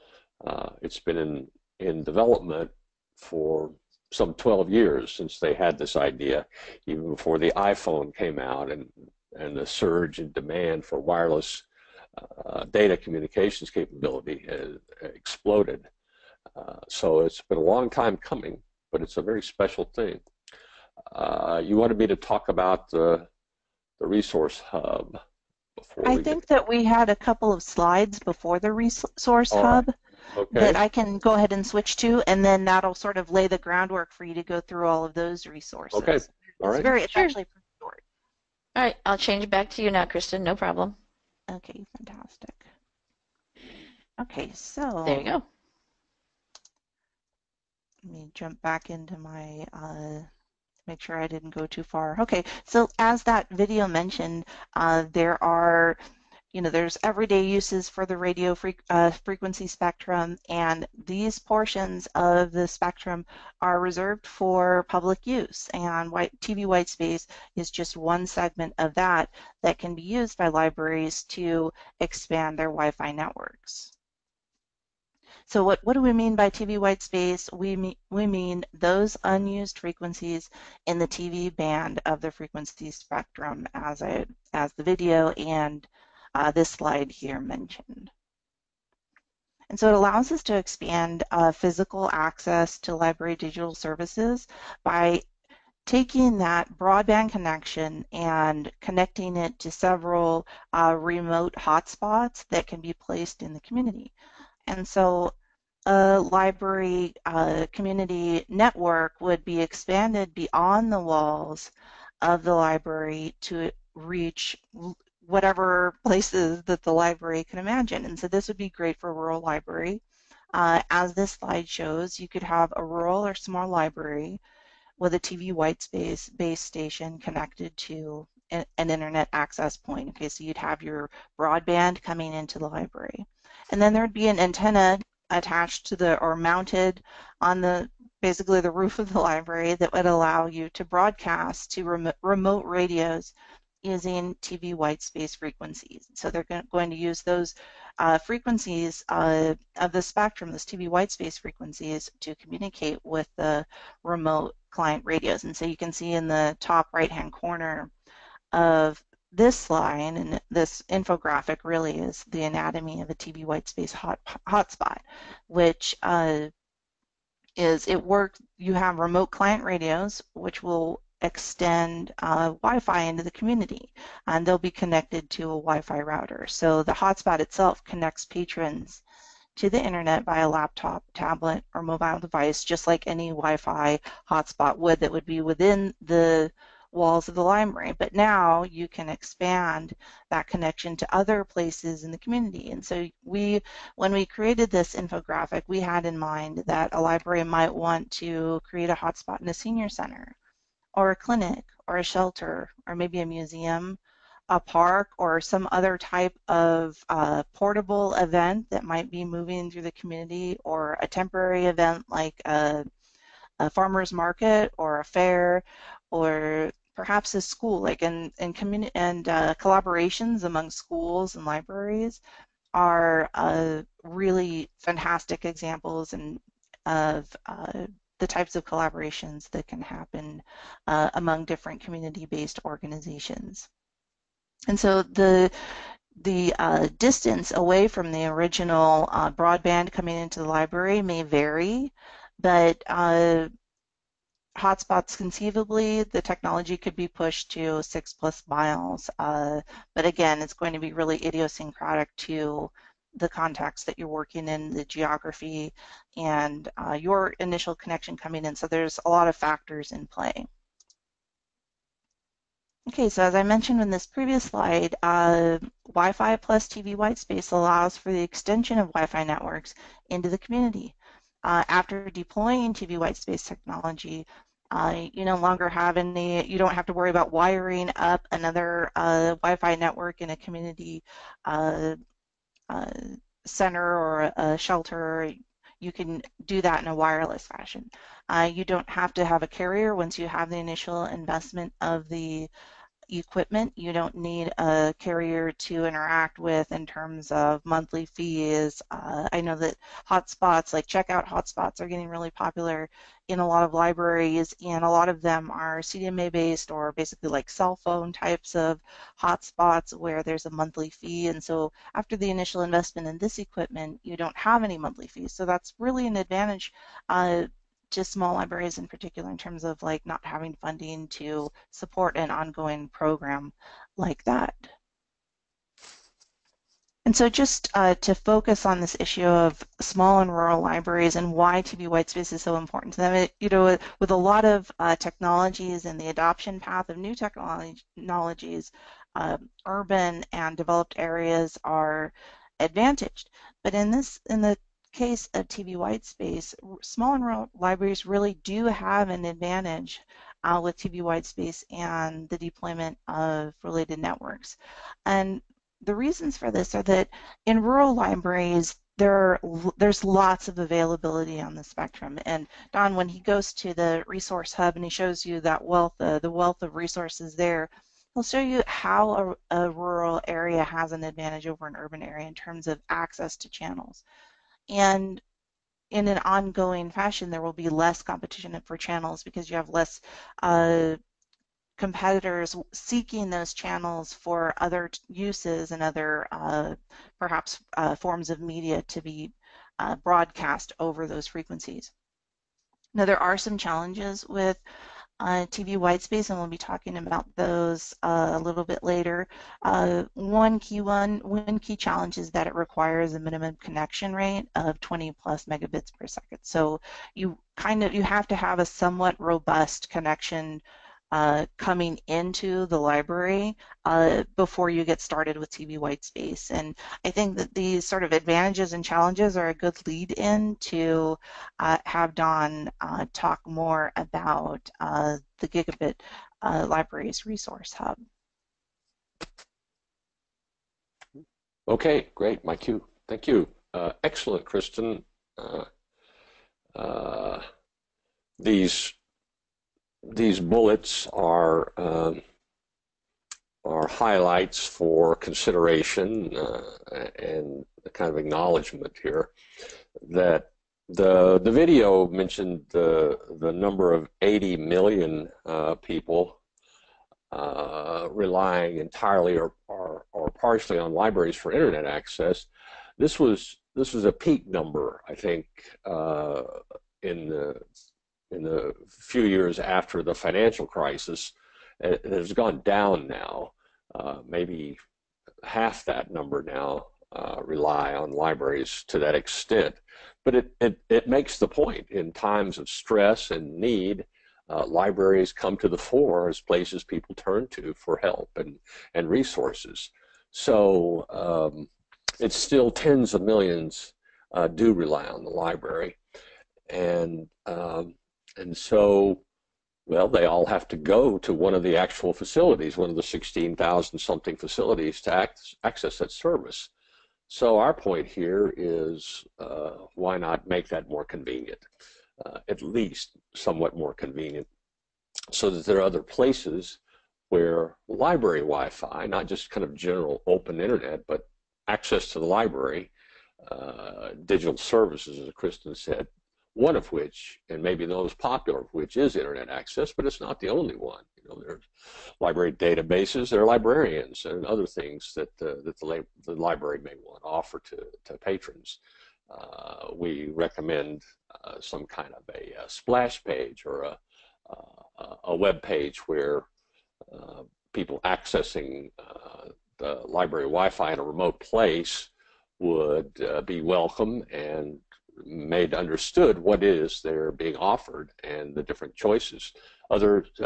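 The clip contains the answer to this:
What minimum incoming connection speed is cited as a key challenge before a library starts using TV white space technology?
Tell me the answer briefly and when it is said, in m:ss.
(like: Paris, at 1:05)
20+ Mbps, at 6:44.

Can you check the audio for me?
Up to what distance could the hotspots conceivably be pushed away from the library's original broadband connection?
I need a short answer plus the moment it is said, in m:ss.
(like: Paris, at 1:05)
6+ miles, at 4:07.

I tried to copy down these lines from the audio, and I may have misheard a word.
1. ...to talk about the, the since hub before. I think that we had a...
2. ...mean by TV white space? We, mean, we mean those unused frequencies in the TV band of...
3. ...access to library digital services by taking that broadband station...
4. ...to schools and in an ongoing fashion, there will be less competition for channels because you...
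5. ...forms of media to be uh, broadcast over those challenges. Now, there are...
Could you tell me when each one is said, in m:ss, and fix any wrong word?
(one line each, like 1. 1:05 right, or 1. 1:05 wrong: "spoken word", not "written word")
1. 0:22 wrong: "resource", not "since"
2. 1:16 right
3. 1:32 wrong: "connection", not "station"
4. 6:13 wrong: "channels", not "schools"
5. 6:27 wrong: "frequencies", not "challenges".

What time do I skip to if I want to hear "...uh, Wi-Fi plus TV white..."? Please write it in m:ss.
4:25.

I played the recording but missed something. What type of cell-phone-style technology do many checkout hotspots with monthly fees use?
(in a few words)
CDMA.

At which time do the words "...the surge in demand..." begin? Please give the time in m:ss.
0:09.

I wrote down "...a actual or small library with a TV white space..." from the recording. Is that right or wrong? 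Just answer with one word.
wrong.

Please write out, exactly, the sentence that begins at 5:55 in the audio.
And the reasons for this are that in rural libraries, there there's lots of availability on the spectrum.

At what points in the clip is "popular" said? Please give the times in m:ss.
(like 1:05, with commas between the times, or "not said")
5:02, 8:48.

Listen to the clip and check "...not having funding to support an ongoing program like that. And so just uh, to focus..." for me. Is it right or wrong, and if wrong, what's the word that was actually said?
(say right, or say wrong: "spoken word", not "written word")
right.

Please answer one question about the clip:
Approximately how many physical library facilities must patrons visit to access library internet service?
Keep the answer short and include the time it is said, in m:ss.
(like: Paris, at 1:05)
16,000, at 8:23.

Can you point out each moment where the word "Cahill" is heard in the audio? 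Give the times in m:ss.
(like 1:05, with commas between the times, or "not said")
not said.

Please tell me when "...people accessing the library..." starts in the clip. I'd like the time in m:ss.
9:07.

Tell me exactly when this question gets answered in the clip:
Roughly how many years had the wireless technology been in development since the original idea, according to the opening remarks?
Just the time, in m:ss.
0:04.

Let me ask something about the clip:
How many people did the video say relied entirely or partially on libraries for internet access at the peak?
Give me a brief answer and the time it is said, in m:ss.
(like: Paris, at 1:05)
80 million, at 7:34.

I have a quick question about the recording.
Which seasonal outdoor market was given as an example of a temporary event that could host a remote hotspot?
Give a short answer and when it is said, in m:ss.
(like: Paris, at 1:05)
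Farmer's market, at 3:33.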